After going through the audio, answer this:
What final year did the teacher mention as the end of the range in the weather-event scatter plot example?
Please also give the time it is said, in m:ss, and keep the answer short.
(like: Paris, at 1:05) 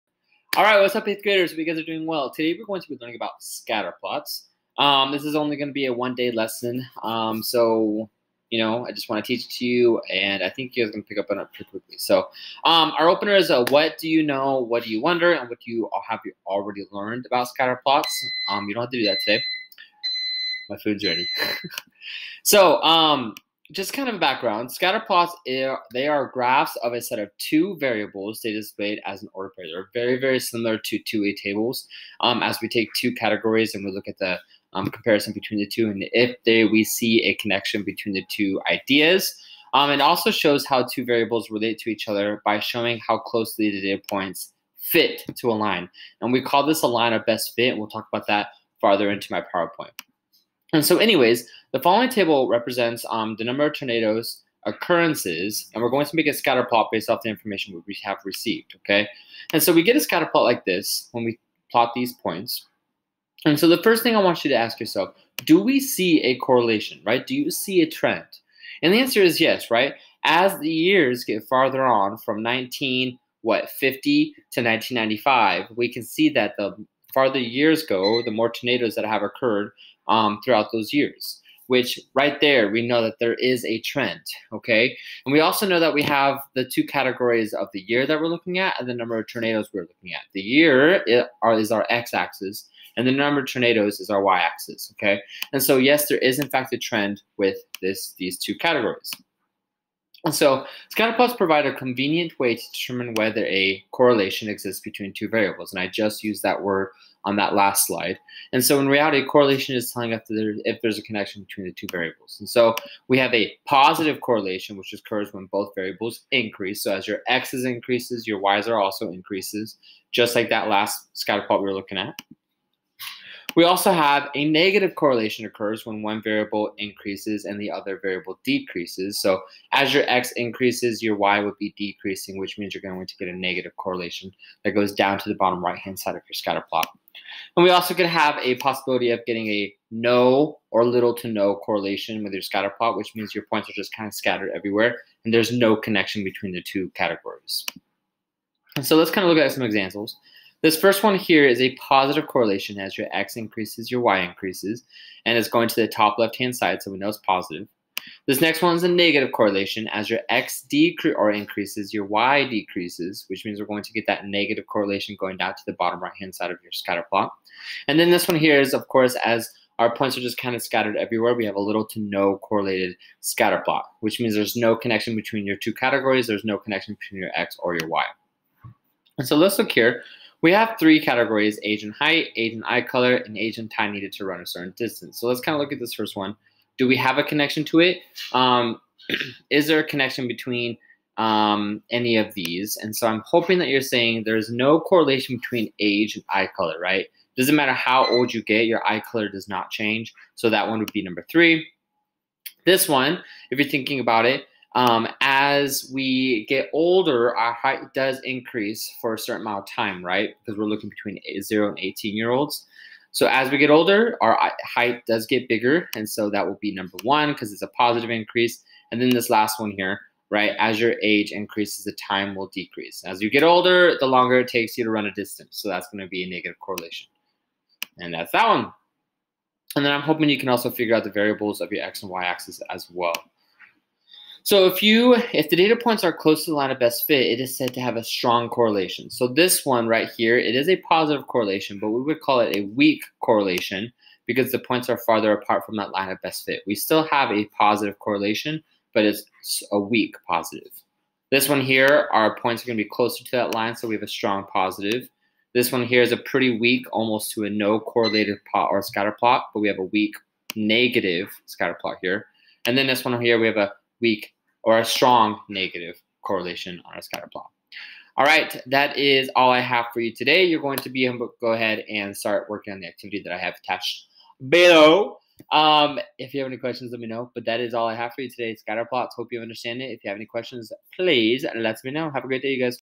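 1995, at 1:14.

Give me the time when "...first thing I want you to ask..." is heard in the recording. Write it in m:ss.
1:03.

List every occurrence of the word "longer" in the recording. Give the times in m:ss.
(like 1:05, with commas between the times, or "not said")
3:44.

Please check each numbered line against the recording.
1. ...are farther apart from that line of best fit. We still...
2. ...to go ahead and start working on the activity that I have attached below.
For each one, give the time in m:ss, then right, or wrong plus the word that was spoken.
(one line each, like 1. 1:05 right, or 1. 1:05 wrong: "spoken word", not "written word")
1. 4:04 right
2. 4:31 right.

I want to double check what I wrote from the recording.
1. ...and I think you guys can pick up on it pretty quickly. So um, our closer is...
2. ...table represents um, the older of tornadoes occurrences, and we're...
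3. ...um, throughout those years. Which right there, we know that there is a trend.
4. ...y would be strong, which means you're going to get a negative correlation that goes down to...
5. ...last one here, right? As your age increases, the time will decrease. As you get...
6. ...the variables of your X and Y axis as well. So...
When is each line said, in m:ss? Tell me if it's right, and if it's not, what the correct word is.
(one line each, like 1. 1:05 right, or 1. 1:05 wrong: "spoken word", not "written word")
1. 0:10 wrong: "opener", not "closer"
2. 0:52 wrong: "number", not "older"
3. 1:20 right
4. 2:11 wrong: "decreasing", not "strong"
5. 3:39 right
6. 3:51 right.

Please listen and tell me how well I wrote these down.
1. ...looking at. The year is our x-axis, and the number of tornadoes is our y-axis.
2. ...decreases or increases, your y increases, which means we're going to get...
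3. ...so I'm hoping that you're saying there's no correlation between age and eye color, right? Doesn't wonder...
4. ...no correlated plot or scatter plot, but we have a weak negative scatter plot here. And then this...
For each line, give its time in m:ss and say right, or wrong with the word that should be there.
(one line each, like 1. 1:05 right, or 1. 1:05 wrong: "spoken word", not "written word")
1. 1:29 right
2. 2:40 wrong: "decreases", not "increases"
3. 3:12 wrong: "matter", not "wonder"
4. 4:17 right.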